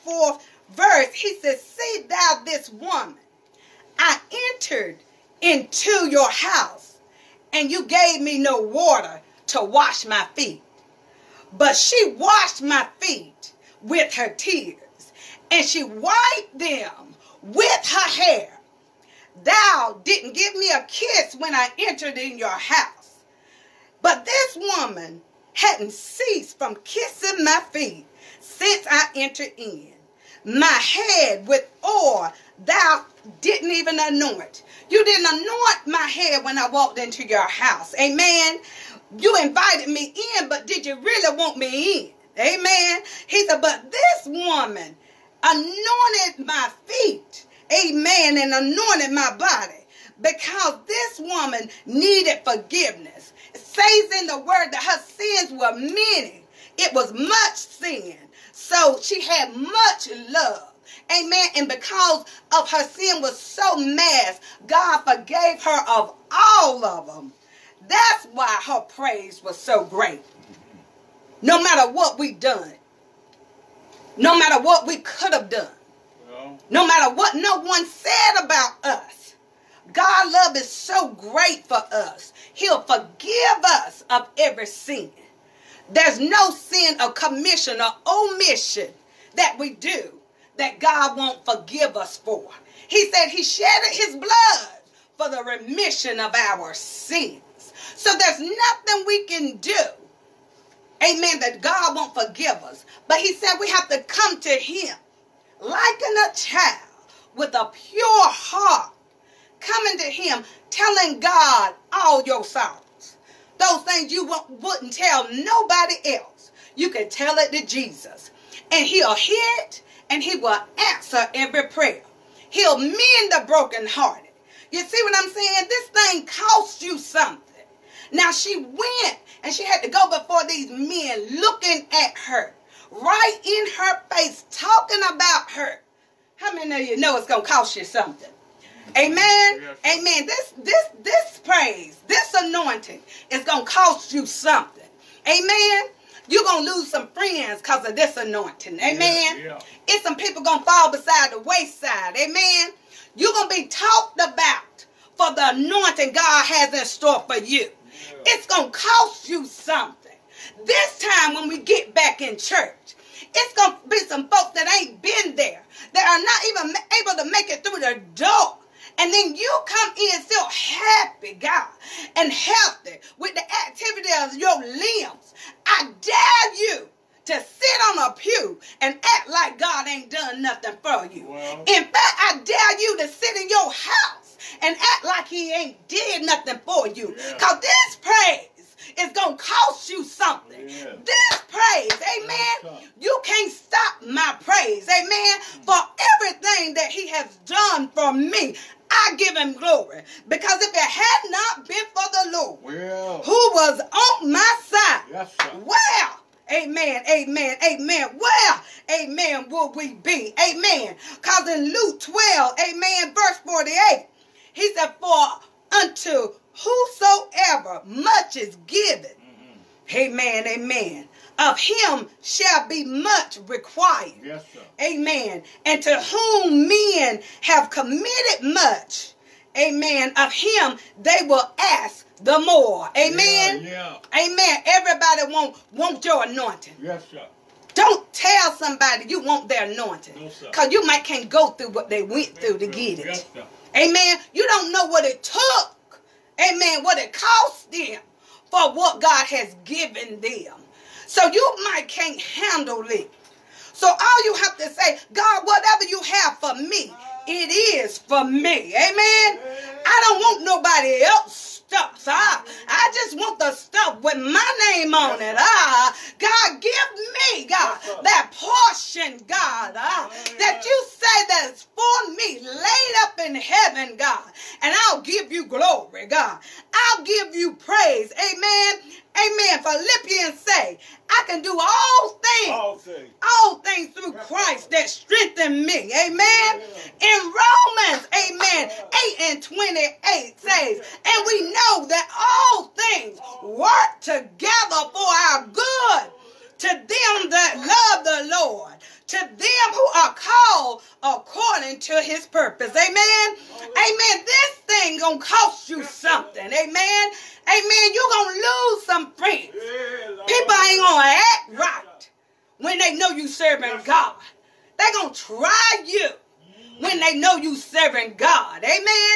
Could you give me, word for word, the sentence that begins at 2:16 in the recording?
How many of you know it's gonna cost you something?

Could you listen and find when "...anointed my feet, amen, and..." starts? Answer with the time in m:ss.
0:45.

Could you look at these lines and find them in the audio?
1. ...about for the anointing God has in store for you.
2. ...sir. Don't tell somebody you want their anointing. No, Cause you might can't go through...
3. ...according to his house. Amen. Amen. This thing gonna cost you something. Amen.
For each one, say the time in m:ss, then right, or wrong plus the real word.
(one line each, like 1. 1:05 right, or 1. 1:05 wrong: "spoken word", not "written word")
1. 2:34 right
2. 3:57 right
3. 5:01 wrong: "purpose", not "house".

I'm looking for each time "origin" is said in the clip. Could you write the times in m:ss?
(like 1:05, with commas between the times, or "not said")
not said.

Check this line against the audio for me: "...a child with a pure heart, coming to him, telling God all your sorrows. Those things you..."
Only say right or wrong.
right.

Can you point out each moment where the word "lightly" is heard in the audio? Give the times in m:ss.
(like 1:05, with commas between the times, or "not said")
not said.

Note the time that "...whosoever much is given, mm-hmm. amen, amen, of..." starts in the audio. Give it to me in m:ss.
3:36.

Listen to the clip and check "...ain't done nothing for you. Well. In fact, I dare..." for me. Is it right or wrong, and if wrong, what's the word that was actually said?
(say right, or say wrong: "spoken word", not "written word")
right.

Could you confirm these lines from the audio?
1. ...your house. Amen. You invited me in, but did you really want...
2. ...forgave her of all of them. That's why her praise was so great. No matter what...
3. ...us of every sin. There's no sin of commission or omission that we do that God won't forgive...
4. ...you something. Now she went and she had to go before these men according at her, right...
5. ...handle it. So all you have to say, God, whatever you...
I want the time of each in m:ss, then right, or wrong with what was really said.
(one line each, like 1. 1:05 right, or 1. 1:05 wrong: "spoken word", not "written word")
1. 0:37 right
2. 1:05 right
3. 1:23 right
4. 2:06 wrong: "looking", not "according"
5. 4:12 right.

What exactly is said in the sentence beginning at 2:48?
And then you come in still happy, God, and healthy with the activity of your limbs.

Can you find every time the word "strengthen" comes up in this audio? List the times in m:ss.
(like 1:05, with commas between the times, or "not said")
4:44.